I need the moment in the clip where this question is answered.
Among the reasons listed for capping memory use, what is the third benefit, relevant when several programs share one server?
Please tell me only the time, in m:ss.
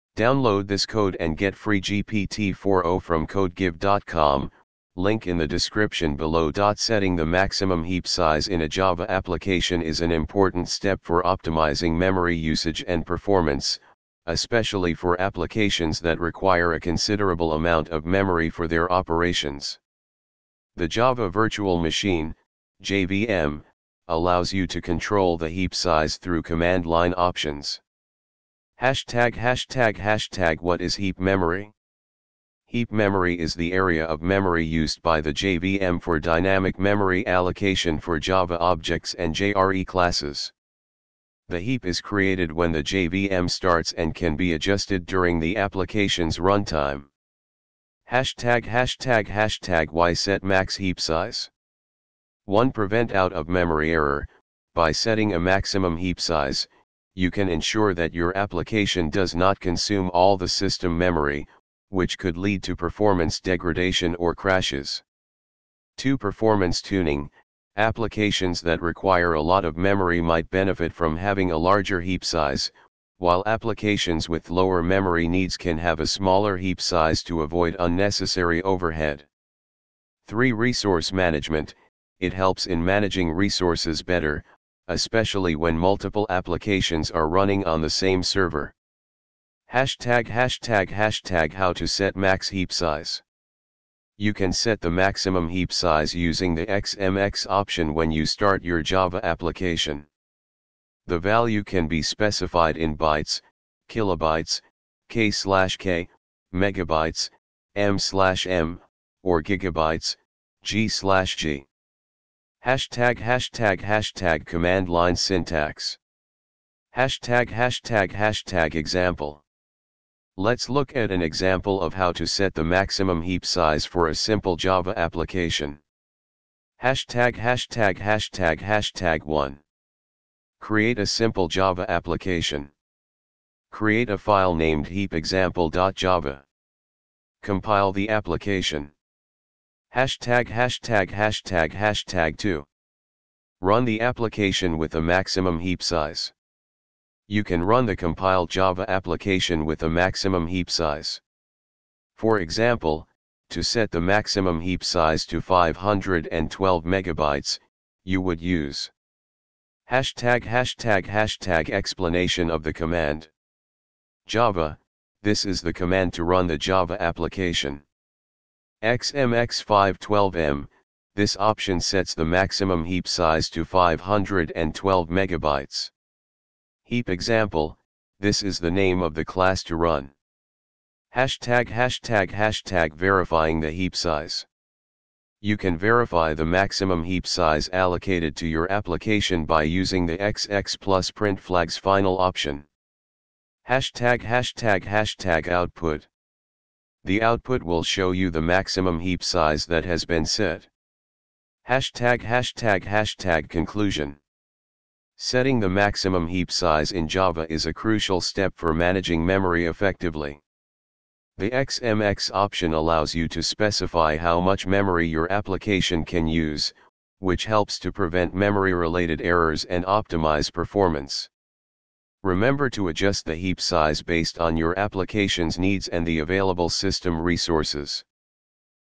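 1:20.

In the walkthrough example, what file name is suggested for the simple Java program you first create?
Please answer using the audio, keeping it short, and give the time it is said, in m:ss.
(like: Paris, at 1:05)
heapexample.java, at 2:14.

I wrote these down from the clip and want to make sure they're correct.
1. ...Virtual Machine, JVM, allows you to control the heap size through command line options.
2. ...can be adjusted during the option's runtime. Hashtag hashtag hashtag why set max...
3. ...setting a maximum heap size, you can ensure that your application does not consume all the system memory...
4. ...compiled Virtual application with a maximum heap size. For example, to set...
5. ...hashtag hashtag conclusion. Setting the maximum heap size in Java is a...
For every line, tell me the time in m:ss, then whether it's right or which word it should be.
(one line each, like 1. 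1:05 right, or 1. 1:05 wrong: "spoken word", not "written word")
1. 0:21 right
2. 0:44 wrong: "application", not "option"
3. 0:54 right
4. 2:27 wrong: "Java", not "Virtual"
5. 3:22 right.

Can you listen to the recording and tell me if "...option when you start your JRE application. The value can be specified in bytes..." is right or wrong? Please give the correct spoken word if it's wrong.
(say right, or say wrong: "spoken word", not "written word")
wrong: "Java", not "JRE".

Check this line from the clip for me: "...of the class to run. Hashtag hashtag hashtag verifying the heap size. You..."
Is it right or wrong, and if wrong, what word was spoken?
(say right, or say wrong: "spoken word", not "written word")
right.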